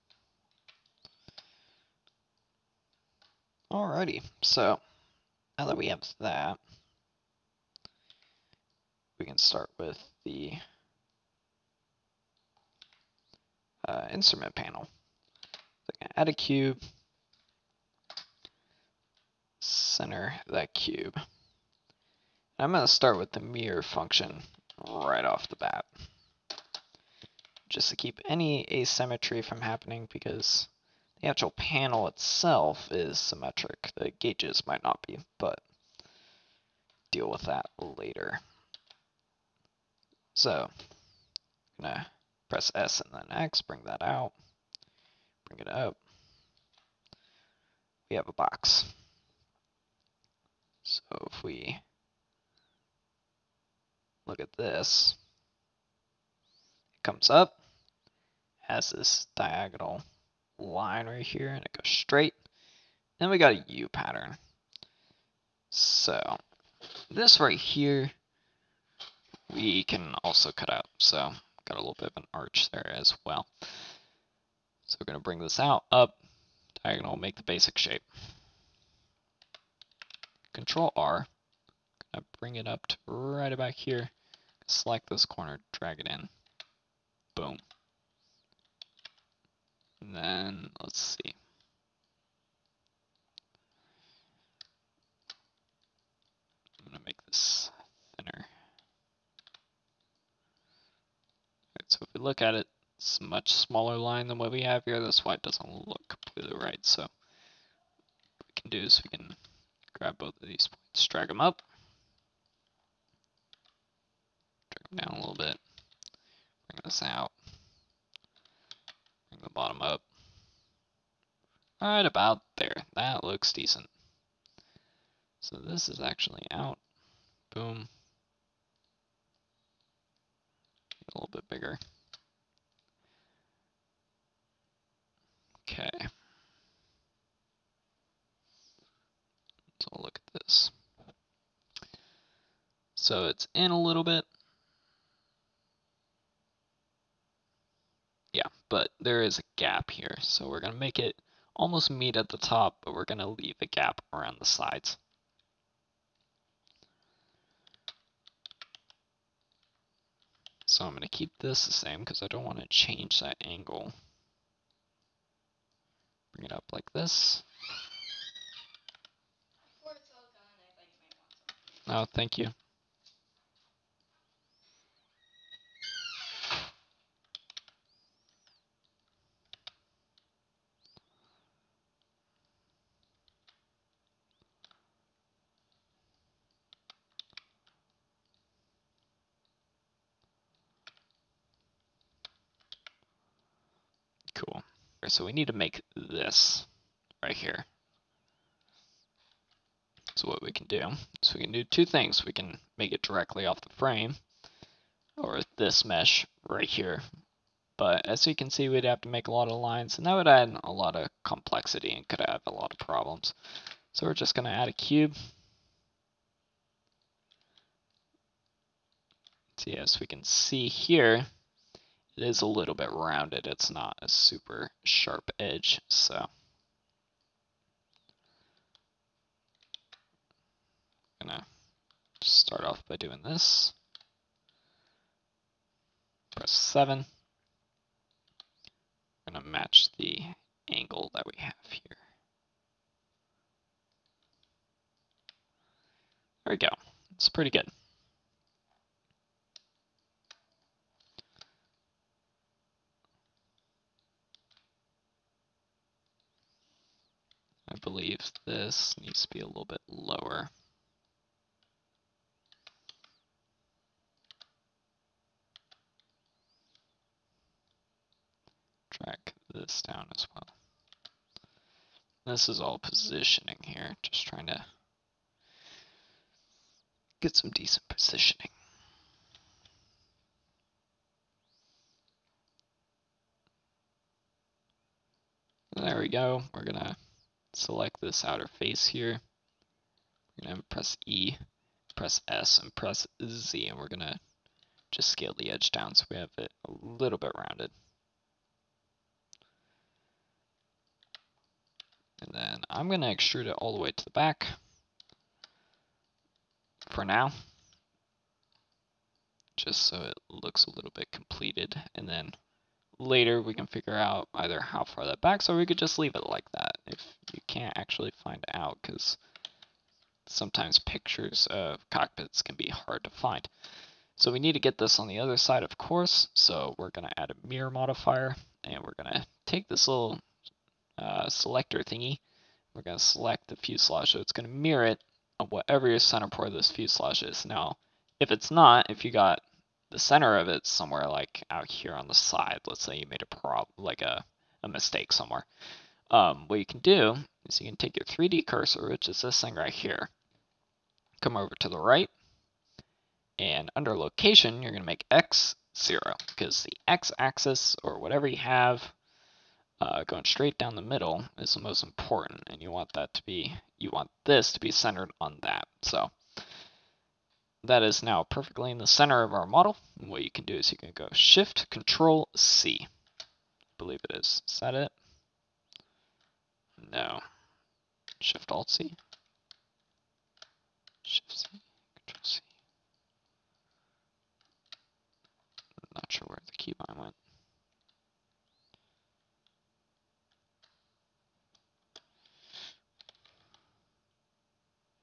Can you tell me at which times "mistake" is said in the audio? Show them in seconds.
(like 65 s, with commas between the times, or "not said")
344 s.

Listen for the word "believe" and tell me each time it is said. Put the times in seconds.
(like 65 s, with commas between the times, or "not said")
257 s, 373 s.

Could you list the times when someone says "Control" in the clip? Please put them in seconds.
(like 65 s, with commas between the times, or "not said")
80 s, 371 s, 382 s.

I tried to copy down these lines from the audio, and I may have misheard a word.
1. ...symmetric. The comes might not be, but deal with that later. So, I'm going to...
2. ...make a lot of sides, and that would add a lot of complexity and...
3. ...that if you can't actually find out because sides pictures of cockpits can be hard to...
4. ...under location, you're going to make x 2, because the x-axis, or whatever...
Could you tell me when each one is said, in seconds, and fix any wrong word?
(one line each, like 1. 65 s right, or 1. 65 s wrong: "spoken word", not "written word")
1. 33 s wrong: "gauges", not "comes"
2. 209 s wrong: "lines", not "sides"
3. 316 s wrong: "sometimes", not "sides"
4. 353 s wrong: "0", not "2".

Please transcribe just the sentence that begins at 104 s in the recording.
That's why it doesn't look completely right.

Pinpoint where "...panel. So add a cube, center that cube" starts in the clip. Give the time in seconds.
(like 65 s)
14 s.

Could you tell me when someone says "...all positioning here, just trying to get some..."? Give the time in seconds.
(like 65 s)
272 s.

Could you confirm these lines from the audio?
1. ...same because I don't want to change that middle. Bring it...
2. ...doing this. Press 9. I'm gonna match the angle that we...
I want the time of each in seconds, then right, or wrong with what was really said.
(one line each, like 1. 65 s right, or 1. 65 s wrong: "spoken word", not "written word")
1. 161 s wrong: "angle", not "middle"
2. 232 s wrong: "7", not "9".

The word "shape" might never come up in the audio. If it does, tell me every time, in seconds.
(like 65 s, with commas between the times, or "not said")
77 s.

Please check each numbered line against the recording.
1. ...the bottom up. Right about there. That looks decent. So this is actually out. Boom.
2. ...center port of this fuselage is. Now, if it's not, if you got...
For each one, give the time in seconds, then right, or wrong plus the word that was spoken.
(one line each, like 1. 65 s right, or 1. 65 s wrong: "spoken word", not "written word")
1. 119 s right
2. 335 s right.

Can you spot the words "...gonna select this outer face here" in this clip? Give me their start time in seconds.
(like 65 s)
286 s.